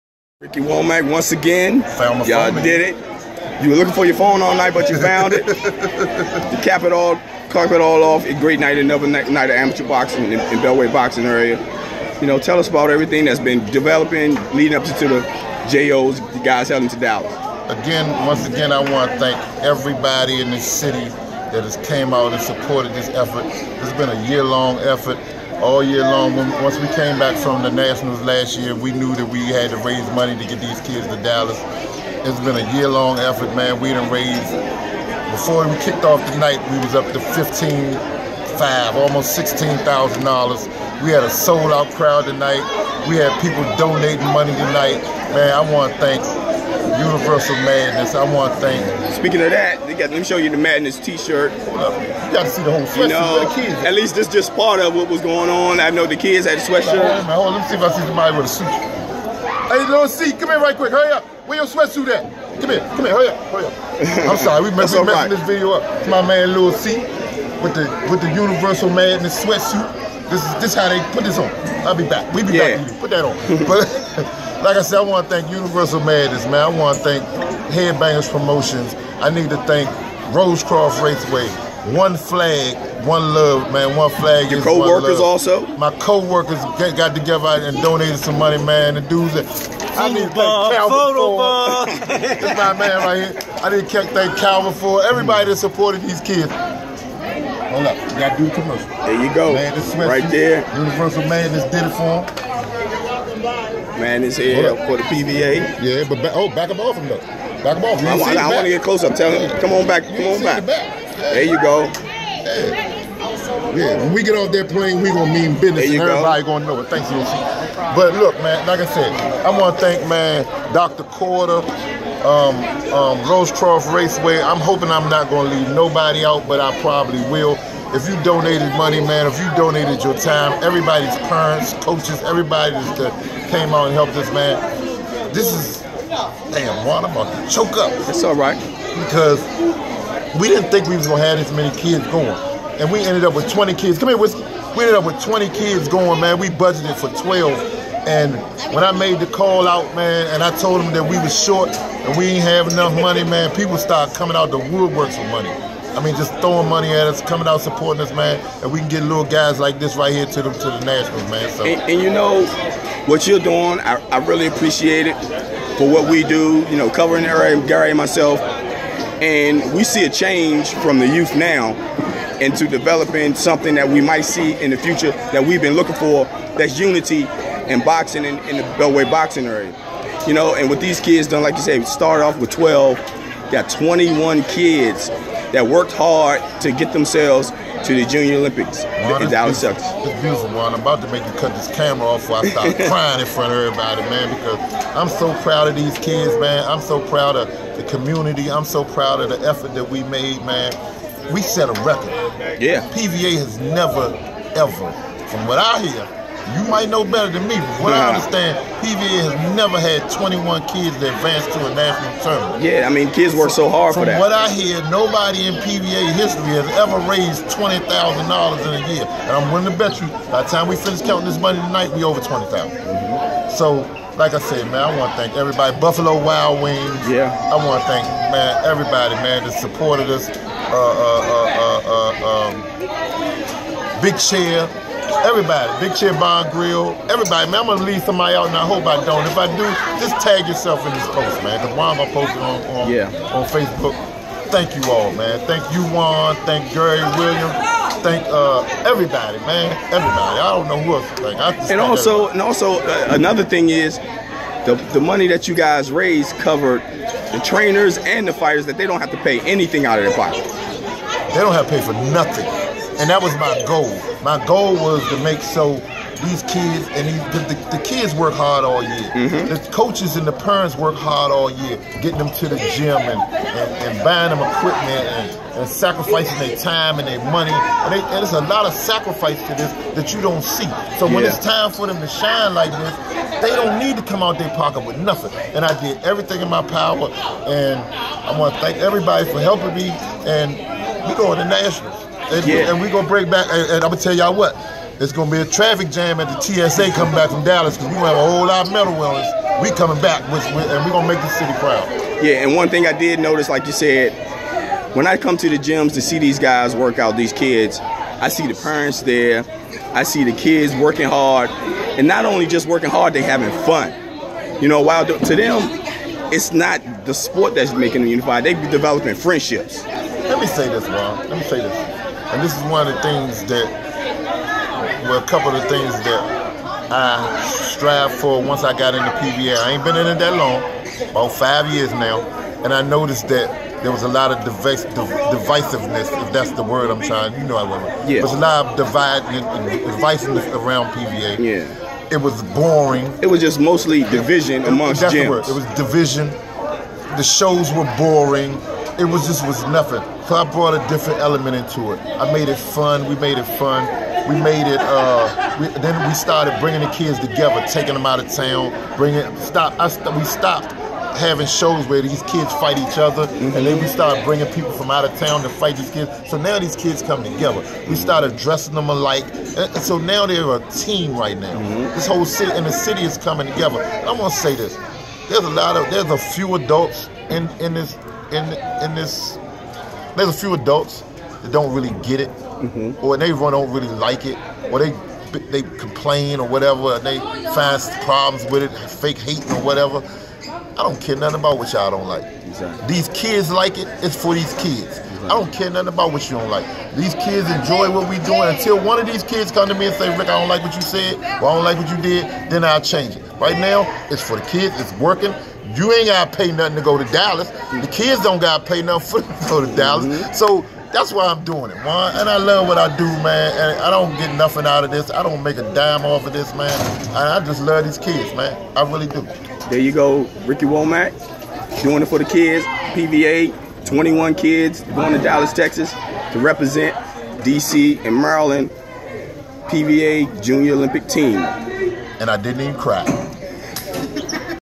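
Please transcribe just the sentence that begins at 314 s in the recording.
You know, while to them, it's not the sport that's making them unified.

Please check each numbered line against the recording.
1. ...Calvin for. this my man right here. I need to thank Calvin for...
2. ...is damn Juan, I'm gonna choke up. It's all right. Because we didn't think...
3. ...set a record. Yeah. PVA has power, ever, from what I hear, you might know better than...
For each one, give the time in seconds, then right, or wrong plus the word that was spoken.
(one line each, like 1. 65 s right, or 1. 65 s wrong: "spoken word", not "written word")
1. 90 s right
2. 135 s right
3. 201 s wrong: "never", not "power".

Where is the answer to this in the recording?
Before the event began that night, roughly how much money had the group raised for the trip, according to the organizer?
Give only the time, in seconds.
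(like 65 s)
38 s.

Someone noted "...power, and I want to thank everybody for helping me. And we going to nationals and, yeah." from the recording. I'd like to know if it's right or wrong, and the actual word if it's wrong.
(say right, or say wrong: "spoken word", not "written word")
right.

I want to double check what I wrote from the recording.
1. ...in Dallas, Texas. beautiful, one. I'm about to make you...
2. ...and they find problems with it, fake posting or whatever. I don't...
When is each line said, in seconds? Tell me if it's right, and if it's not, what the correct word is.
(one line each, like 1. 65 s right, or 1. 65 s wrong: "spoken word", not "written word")
1. 189 s right
2. 386 s wrong: "hating", not "posting".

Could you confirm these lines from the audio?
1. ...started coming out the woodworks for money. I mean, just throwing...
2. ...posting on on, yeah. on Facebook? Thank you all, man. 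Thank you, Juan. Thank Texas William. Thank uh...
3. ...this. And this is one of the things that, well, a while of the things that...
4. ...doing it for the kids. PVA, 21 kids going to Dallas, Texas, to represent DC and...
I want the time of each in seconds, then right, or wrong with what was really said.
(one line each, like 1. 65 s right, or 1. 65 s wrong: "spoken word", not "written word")
1. 153 s right
2. 242 s wrong: "Gary", not "Texas"
3. 321 s wrong: "couple", not "while"
4. 421 s right.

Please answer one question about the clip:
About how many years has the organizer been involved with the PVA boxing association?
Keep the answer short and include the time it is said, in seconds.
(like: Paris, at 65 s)
5, at 331 s.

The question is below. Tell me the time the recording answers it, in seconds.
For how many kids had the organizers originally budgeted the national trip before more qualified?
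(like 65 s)
146 s.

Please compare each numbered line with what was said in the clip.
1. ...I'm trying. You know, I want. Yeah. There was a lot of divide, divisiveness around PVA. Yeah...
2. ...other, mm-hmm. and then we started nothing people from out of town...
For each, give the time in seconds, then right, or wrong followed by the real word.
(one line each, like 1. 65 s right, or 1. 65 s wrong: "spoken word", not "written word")
1. 336 s right
2. 362 s wrong: "bringing", not "nothing".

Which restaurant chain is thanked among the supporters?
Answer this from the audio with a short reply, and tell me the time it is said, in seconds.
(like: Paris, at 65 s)
Buffalo Wild Wings, at 225 s.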